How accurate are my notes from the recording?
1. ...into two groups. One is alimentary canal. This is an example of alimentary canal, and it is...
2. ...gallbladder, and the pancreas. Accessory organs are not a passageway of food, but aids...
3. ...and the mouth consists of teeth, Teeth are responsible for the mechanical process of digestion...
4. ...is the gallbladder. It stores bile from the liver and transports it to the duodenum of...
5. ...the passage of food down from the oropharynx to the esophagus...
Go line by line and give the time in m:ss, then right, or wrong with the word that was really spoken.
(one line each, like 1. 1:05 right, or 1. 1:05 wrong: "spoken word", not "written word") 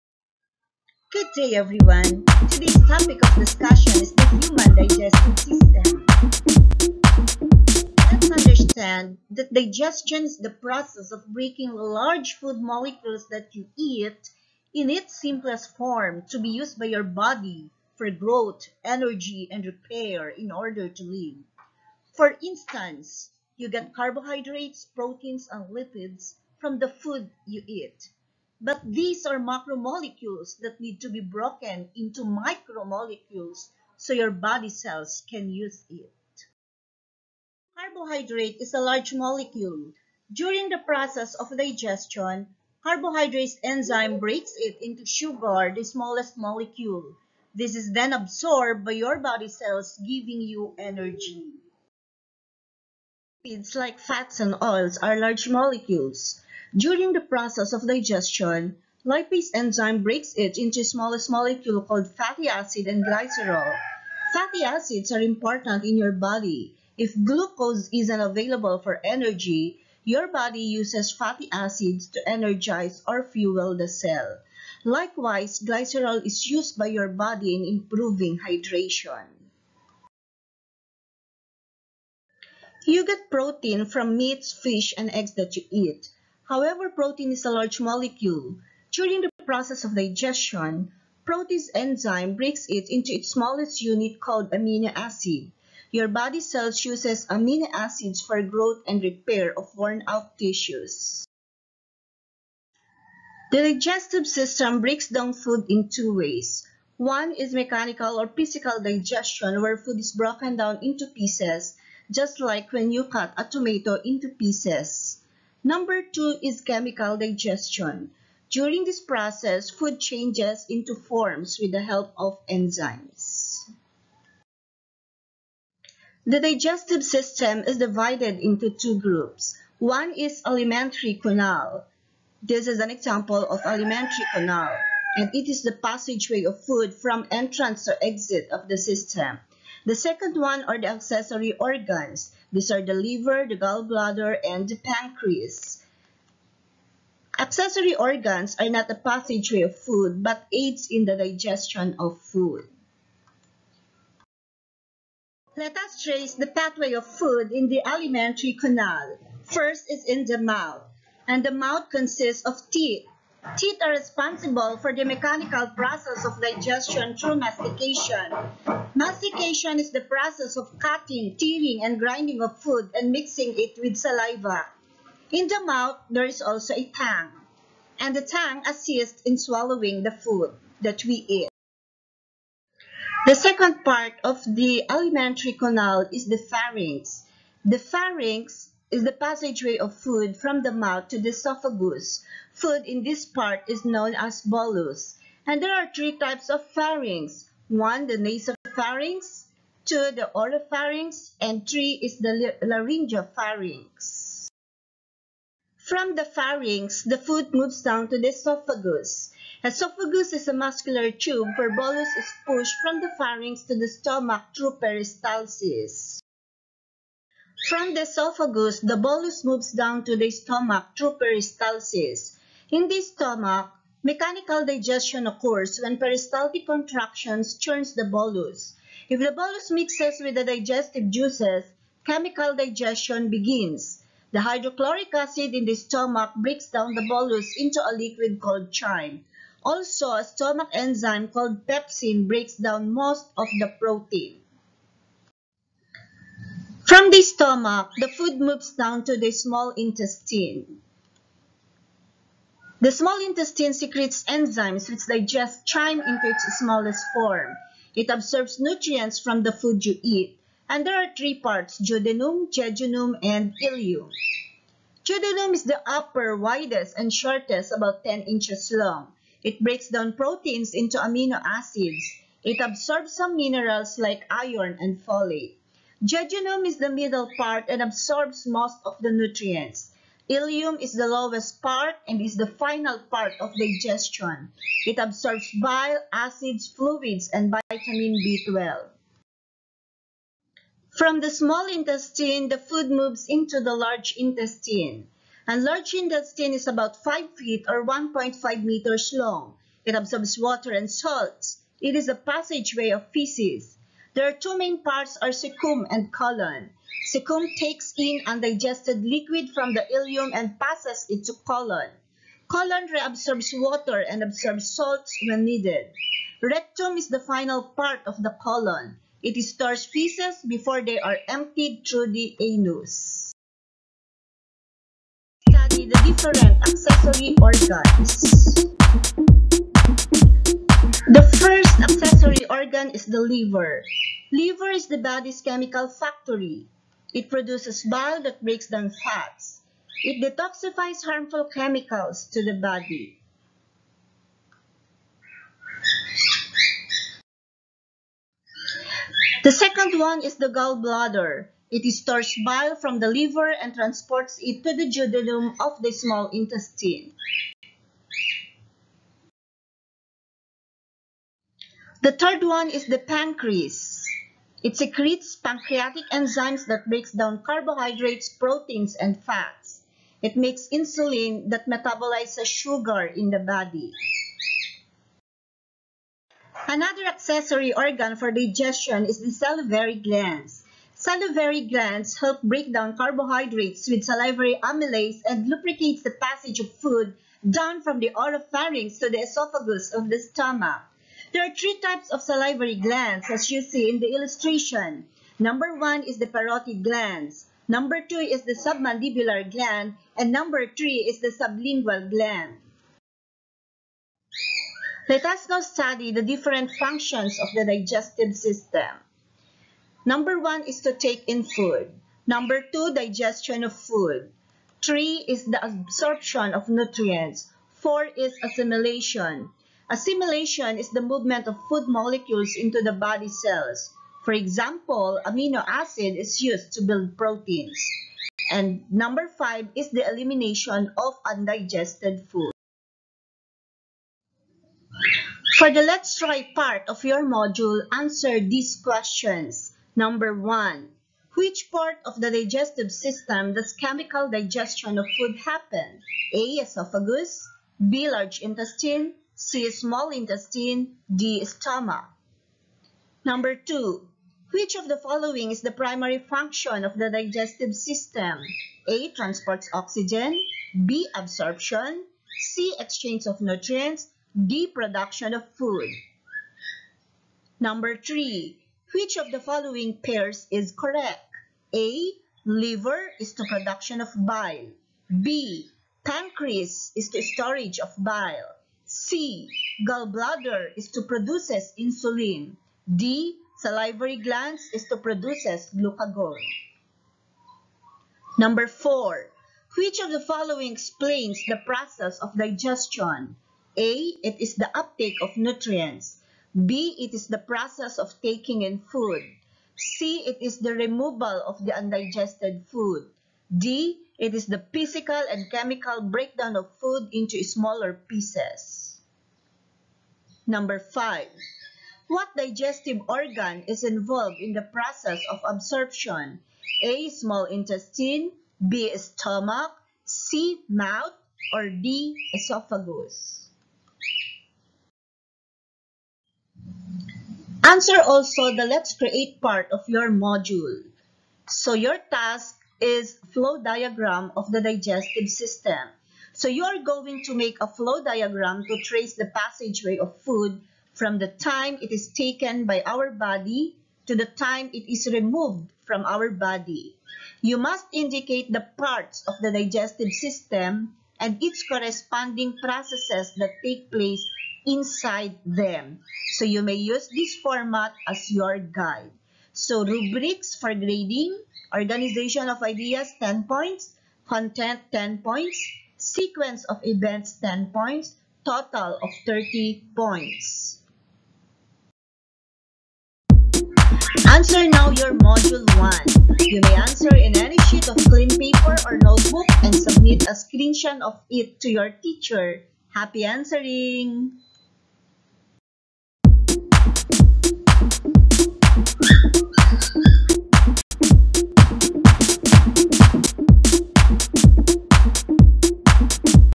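1. 2:08 right
2. 2:23 right
3. 2:41 right
4. 5:50 right
5. 6:26 right.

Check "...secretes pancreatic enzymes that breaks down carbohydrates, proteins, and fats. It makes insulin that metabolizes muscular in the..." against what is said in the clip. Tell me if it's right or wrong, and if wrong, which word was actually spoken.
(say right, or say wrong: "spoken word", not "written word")
wrong: "sugar", not "muscular".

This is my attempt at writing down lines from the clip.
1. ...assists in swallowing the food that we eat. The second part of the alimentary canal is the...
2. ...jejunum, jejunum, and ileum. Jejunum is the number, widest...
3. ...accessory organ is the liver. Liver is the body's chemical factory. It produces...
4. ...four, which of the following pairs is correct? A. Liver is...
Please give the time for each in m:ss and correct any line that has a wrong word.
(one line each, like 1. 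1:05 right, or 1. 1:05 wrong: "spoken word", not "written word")
1. 2:58 right
2. 4:21 wrong: "upper", not "number"
3. 5:31 right
4. 7:47 wrong: "three", not "four".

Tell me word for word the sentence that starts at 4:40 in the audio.
Ileum is the lowest part and is the final part of digestion.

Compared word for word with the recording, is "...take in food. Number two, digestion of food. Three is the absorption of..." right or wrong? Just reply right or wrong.
right.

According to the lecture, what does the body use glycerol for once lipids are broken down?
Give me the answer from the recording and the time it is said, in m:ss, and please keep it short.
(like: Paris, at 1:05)
Improving hydration, at 1:17.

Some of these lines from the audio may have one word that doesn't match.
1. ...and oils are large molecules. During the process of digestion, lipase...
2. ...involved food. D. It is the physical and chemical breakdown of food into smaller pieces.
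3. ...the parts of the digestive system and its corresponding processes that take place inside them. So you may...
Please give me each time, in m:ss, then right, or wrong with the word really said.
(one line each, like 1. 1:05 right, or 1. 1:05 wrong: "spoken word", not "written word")
1. 0:54 right
2. 8:21 wrong: "undigested", not "involved"
3. 9:08 right.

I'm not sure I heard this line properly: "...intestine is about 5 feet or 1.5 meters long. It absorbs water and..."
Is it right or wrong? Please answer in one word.
right.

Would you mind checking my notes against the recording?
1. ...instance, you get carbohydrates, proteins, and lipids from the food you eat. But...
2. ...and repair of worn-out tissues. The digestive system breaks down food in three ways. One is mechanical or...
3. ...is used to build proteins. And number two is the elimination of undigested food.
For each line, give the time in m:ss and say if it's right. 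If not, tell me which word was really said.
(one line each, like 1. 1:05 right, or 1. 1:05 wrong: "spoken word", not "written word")
1. 0:22 right
2. 1:38 wrong: "two", not "three"
3. 7:06 wrong: "five", not "two".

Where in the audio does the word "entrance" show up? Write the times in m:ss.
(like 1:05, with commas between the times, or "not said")
2:17.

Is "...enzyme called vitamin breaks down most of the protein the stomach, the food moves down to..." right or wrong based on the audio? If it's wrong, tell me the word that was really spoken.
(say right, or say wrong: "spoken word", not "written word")
wrong: "pepsin", not "vitamin".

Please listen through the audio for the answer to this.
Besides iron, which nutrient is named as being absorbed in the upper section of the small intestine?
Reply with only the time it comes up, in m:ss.
4:35.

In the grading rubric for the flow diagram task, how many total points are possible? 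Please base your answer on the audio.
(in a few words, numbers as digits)
30 points.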